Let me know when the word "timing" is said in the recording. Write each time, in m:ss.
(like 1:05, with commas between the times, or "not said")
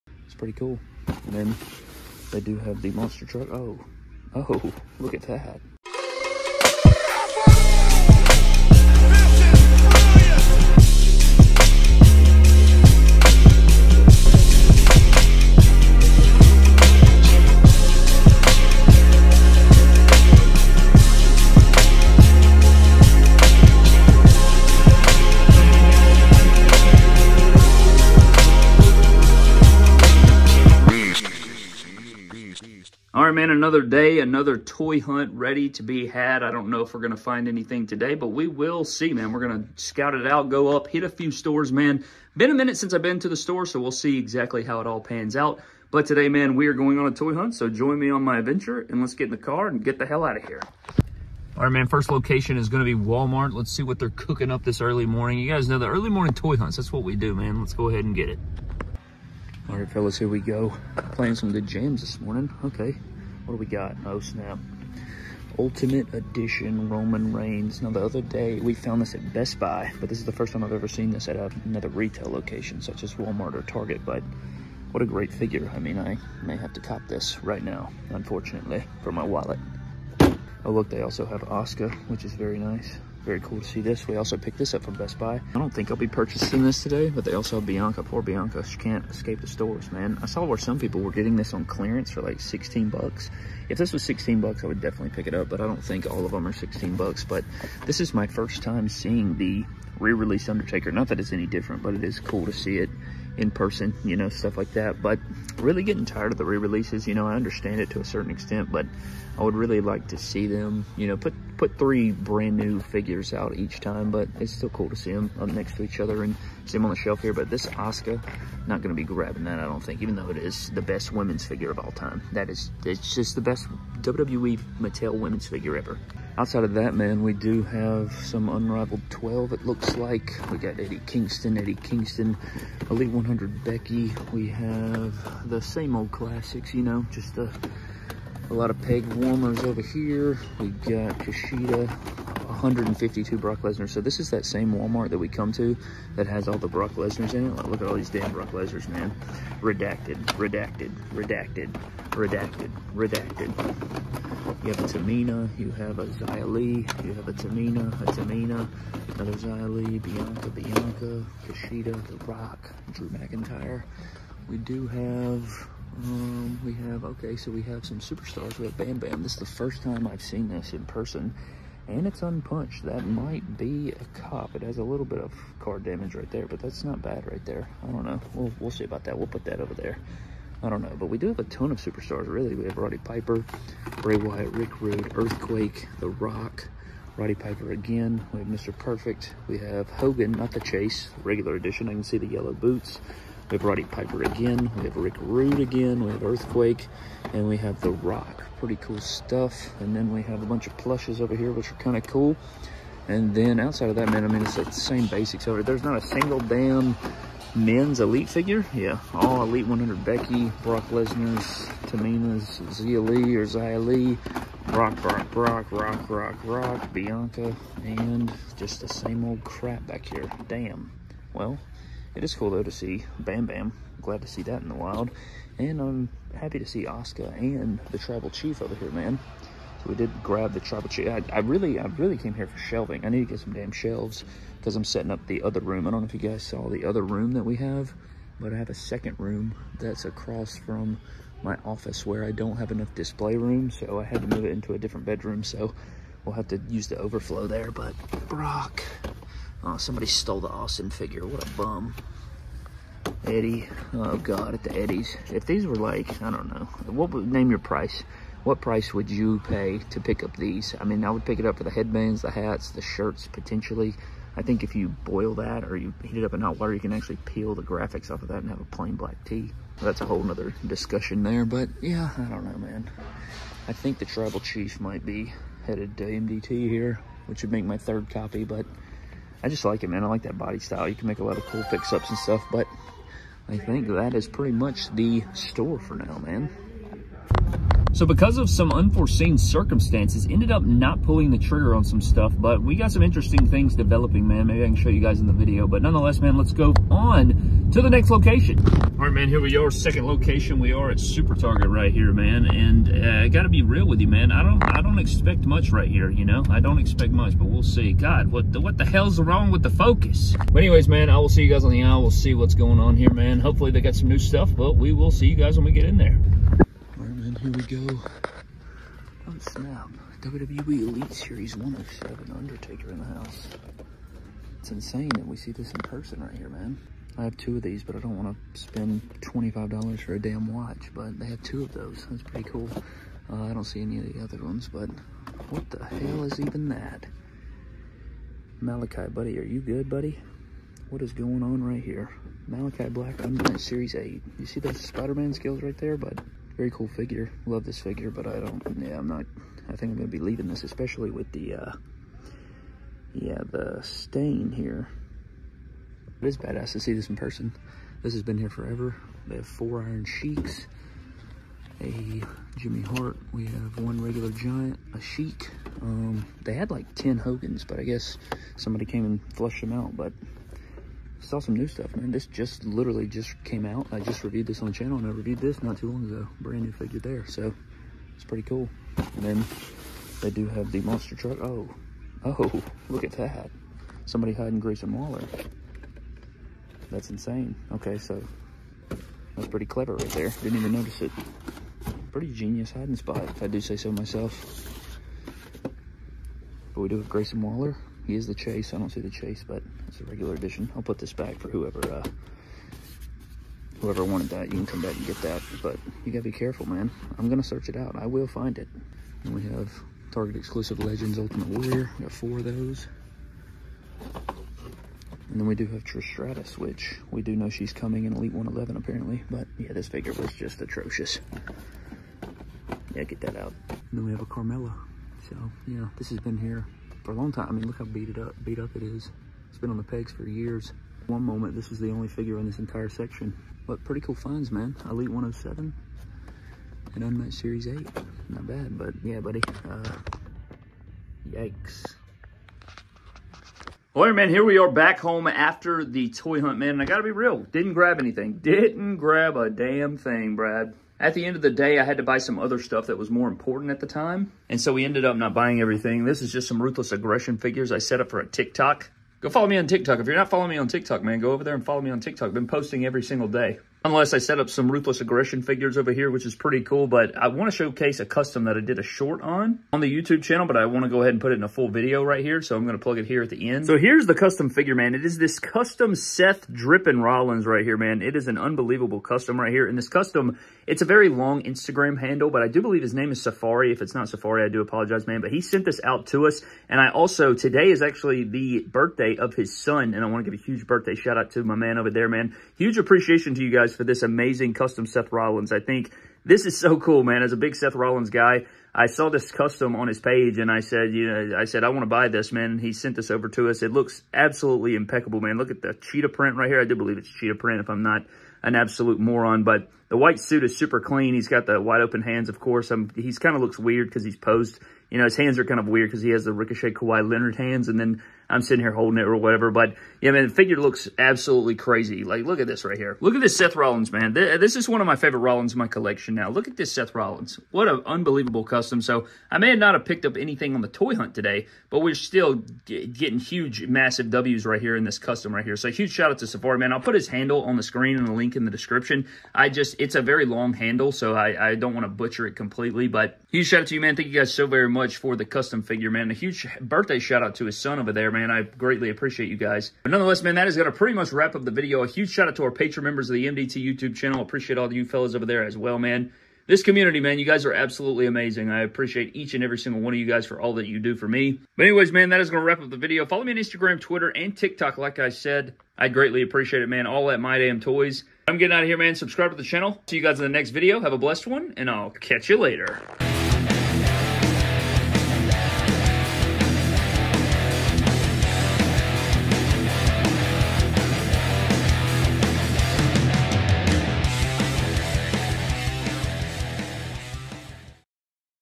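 not said.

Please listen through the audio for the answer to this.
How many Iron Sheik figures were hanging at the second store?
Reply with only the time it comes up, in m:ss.
5:59.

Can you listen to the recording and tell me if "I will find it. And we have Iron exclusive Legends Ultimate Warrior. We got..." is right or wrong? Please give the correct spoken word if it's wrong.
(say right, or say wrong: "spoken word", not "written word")
wrong: "Target", not "Iron".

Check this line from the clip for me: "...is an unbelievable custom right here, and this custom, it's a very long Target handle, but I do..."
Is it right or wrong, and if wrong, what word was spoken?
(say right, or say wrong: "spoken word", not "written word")
wrong: "Instagram", not "Target".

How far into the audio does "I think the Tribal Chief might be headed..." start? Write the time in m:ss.
4:33.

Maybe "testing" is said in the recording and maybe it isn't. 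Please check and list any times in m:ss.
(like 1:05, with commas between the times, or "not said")
not said.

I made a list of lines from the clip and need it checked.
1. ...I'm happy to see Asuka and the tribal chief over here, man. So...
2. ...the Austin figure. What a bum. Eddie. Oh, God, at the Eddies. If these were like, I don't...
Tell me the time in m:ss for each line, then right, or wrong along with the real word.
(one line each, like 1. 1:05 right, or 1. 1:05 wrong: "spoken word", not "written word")
1. 3:45 right
2. 4:10 right.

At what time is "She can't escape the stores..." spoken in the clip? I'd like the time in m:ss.
1:28.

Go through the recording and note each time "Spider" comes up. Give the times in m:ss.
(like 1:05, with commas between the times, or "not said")
5:44.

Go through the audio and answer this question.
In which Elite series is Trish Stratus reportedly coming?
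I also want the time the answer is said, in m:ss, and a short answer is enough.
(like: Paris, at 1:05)
Elite 111, at 6:58.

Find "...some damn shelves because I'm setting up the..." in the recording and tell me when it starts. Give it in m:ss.
3:53.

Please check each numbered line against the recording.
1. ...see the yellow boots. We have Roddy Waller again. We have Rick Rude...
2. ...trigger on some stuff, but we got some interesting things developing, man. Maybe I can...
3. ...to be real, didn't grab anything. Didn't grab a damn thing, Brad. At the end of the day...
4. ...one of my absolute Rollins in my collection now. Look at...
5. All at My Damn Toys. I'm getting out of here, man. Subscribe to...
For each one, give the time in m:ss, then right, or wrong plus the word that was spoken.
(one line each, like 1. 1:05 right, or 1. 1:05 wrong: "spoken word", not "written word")
1. 3:12 wrong: "Piper", not "Waller"
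2. 4:51 right
3. 7:26 right
4. 8:44 wrong: "favorite", not "absolute"
5. 9:26 right.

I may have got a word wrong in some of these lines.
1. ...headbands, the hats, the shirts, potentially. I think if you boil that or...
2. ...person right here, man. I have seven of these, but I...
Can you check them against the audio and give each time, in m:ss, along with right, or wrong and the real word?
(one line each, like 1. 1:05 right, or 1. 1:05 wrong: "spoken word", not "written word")
1. 4:21 right
2. 5:25 wrong: "two", not "seven".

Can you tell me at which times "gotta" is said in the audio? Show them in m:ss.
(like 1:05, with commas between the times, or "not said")
5:03, 6:46.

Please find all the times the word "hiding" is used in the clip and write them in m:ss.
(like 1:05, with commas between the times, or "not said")
6:24, 6:32.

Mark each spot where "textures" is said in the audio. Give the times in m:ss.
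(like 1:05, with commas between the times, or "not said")
not said.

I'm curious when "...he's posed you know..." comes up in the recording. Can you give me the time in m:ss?
8:34.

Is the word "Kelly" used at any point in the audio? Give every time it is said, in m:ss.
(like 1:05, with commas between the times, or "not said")
not said.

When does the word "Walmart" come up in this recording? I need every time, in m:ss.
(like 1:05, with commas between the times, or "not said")
0:52, 1:13, 2:24.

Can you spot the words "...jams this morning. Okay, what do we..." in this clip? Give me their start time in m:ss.
1:01.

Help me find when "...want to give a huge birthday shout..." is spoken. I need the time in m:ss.
8:10.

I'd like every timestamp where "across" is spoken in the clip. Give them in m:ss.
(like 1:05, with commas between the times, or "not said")
4:00.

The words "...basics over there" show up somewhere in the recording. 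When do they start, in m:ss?
3:25.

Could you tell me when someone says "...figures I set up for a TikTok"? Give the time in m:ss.
7:37.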